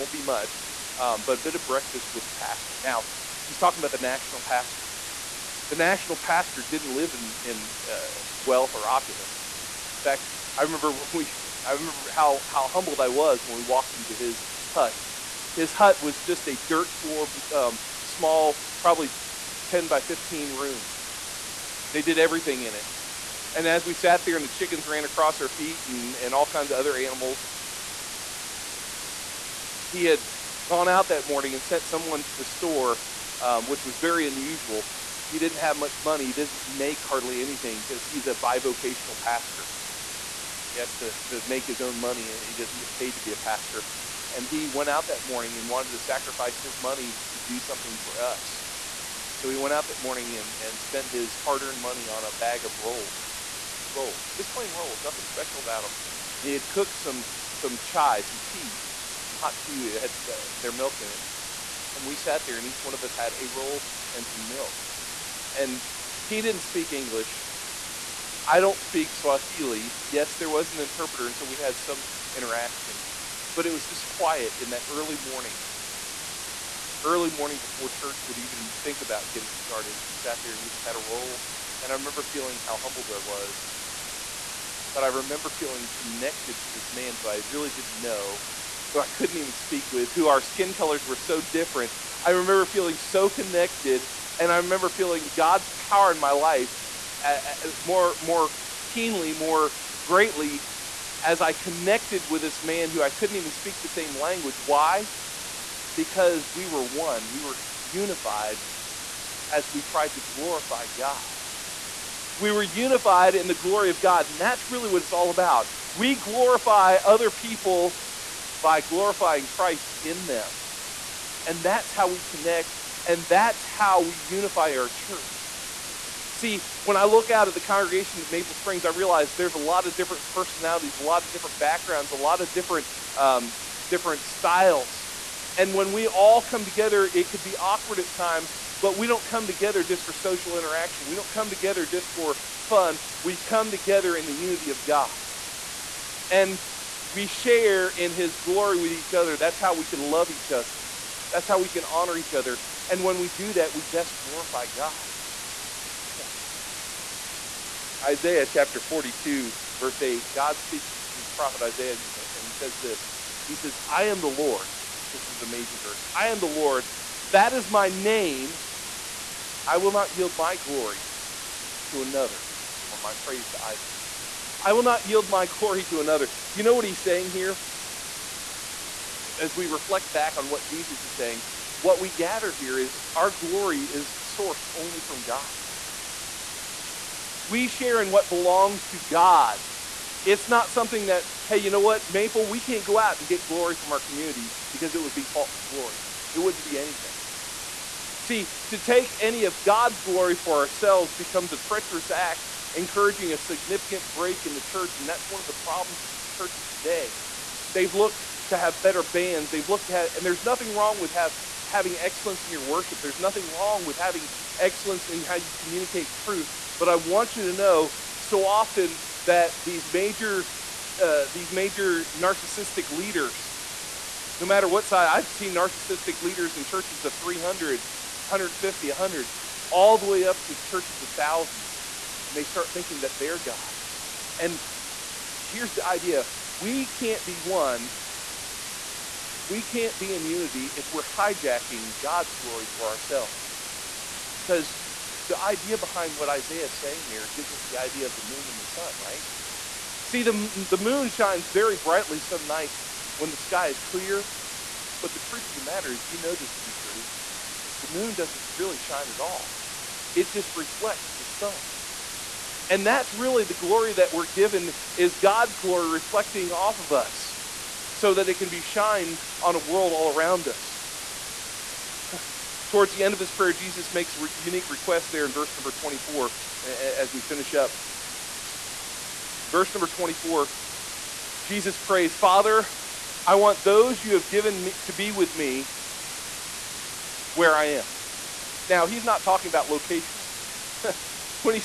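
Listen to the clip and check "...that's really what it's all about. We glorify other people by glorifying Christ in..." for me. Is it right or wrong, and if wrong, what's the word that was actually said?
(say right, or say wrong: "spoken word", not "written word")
right.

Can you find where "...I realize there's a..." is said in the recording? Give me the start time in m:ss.
2:08.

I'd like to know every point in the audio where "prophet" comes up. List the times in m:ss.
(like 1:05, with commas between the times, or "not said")
2:41.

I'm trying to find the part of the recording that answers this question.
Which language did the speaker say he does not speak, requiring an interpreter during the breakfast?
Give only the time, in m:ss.
1:09.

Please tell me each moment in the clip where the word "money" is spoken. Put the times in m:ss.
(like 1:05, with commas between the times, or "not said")
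0:36, 0:42, 0:46, 0:51.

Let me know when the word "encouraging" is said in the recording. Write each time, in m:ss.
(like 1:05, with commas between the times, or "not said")
3:22.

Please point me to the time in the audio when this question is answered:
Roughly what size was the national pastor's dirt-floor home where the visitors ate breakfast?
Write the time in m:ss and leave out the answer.
0:19.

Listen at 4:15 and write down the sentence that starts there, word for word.
But the truth of the matter is, you know this to be true.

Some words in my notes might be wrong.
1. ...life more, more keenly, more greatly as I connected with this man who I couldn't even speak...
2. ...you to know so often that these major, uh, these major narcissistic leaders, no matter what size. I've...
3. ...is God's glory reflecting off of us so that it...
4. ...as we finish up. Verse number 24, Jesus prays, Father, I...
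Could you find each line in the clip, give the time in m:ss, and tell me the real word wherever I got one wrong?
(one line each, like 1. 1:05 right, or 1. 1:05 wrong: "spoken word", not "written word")
1. 1:36 right
2. 3:37 right
3. 4:24 right
4. 4:36 right.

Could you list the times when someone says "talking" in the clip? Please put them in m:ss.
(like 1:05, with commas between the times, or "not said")
0:03, 4:49.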